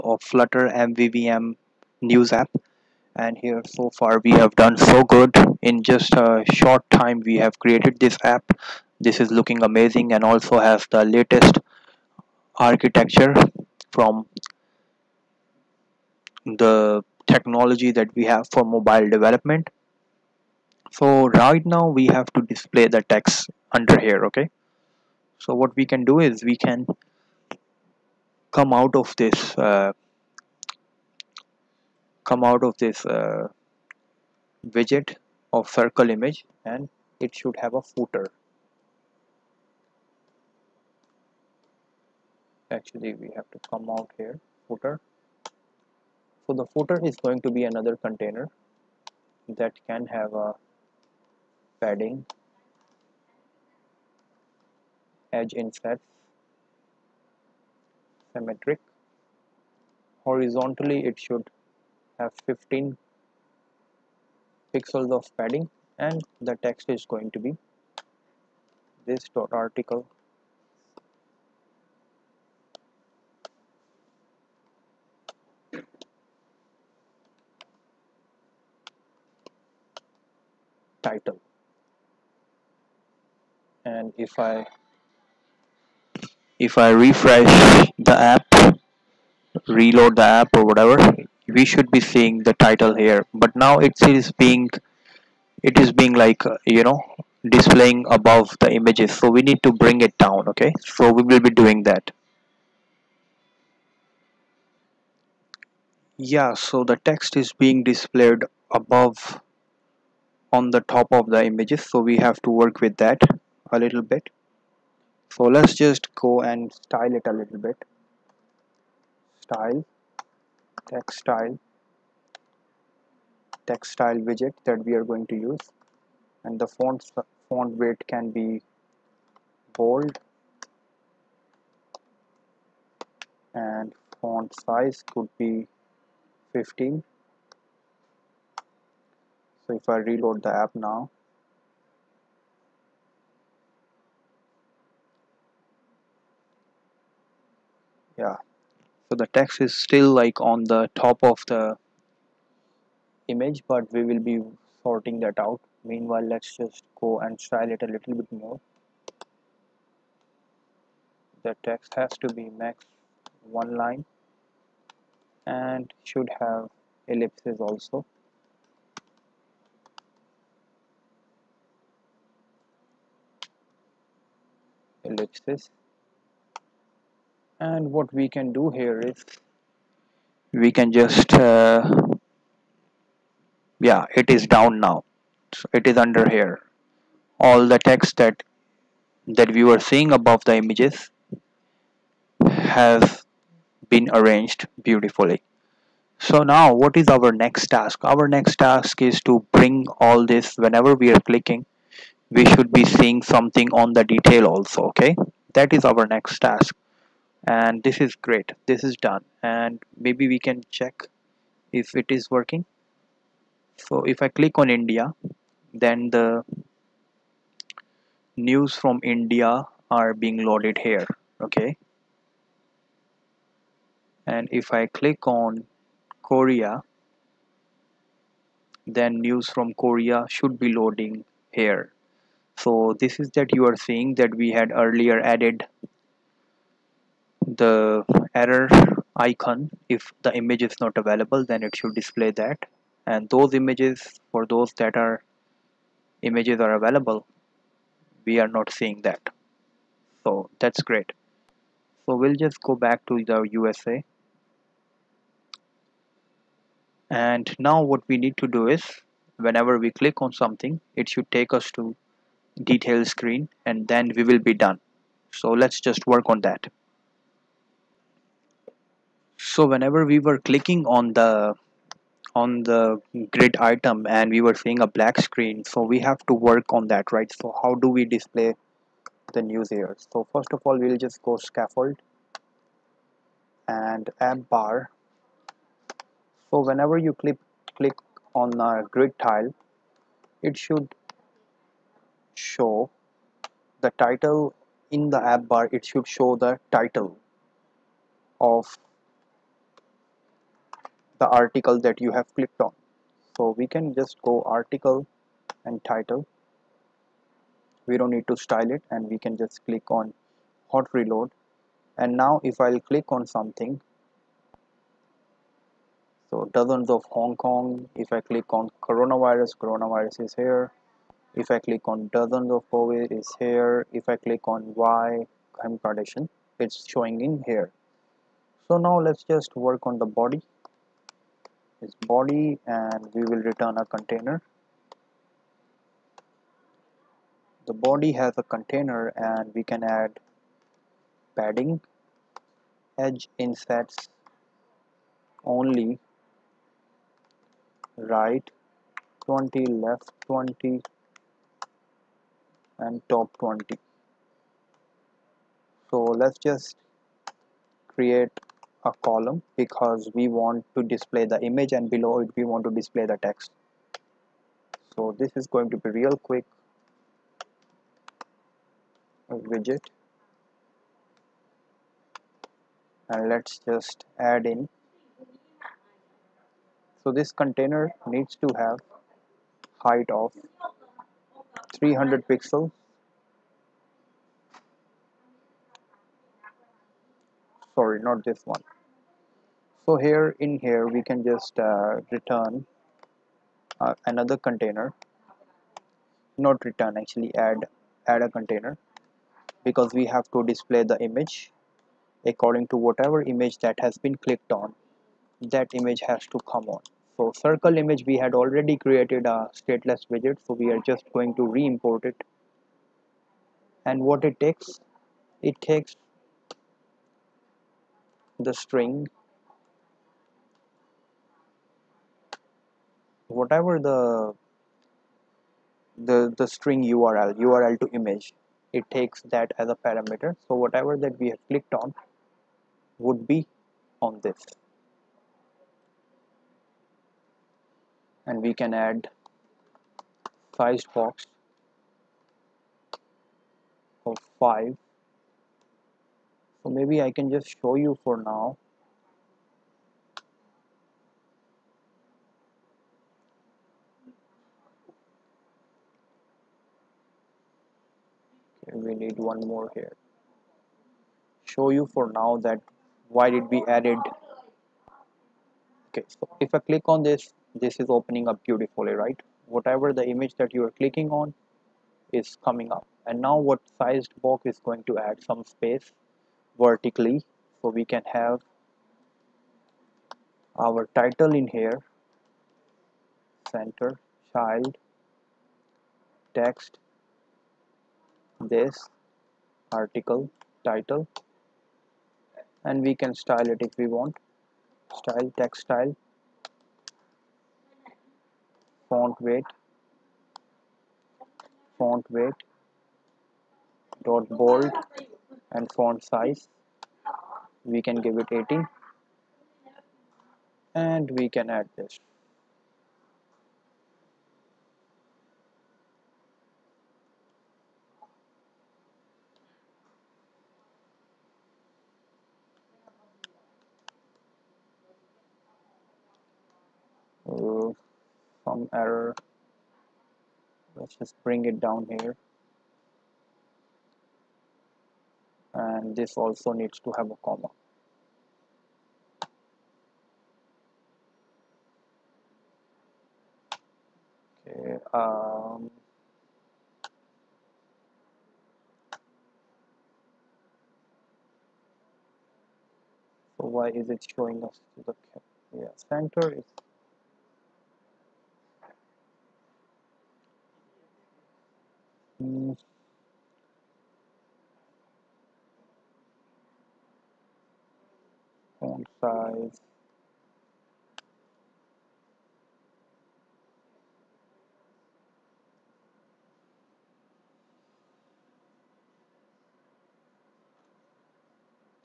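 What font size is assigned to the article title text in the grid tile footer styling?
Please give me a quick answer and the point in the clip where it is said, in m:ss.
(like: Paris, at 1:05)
15, at 2:14.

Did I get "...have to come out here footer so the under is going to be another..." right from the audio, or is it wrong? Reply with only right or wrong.
wrong.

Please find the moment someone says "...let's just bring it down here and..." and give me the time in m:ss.
8:50.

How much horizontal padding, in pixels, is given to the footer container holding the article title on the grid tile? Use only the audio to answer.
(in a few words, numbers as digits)
15.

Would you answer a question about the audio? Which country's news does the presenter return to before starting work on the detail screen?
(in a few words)
USA.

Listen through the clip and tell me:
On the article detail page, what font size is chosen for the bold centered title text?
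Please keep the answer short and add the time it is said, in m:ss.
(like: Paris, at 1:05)
18, at 8:25.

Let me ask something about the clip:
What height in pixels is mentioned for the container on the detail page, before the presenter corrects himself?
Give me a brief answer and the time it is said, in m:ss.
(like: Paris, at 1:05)
300, at 6:21.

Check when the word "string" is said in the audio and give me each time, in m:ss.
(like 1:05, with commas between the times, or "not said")
6:58, 7:06.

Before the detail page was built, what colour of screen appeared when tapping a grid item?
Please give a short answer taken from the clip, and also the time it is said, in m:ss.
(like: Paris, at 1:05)
black, at 4:34.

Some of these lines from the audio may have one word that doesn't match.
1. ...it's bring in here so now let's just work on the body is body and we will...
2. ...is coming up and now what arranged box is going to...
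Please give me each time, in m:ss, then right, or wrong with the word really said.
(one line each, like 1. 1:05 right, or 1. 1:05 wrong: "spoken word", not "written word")
1. 5:26 wrong: "showing", not "bring"
2. 7:52 wrong: "sized", not "arranged".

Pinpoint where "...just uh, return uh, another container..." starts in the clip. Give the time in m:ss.
6:31.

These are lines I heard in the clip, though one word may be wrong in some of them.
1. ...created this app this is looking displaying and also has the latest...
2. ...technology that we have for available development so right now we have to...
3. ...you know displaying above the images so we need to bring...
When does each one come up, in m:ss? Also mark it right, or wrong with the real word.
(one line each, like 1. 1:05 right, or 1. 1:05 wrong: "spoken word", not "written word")
1. 0:07 wrong: "amazing", not "displaying"
2. 0:17 wrong: "mobile", not "available"
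3. 1:36 right.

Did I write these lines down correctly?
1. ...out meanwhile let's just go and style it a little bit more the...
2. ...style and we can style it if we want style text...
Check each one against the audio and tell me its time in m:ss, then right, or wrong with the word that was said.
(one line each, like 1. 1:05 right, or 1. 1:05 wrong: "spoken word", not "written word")
1. 2:35 right
2. 8:10 wrong: "title", not "style".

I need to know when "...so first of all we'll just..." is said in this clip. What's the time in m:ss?
4:40.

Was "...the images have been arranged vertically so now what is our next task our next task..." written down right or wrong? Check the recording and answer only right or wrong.
wrong.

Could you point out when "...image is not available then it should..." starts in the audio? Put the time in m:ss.
4:00.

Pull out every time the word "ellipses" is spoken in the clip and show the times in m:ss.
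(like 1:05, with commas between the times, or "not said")
2:47, 2:55.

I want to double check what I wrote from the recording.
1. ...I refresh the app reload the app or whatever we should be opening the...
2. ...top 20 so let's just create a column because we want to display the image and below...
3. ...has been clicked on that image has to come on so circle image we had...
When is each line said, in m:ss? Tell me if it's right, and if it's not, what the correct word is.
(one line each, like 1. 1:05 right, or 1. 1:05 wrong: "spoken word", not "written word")
1. 1:26 wrong: "seeing", not "opening"
2. 5:53 right
3. 6:43 right.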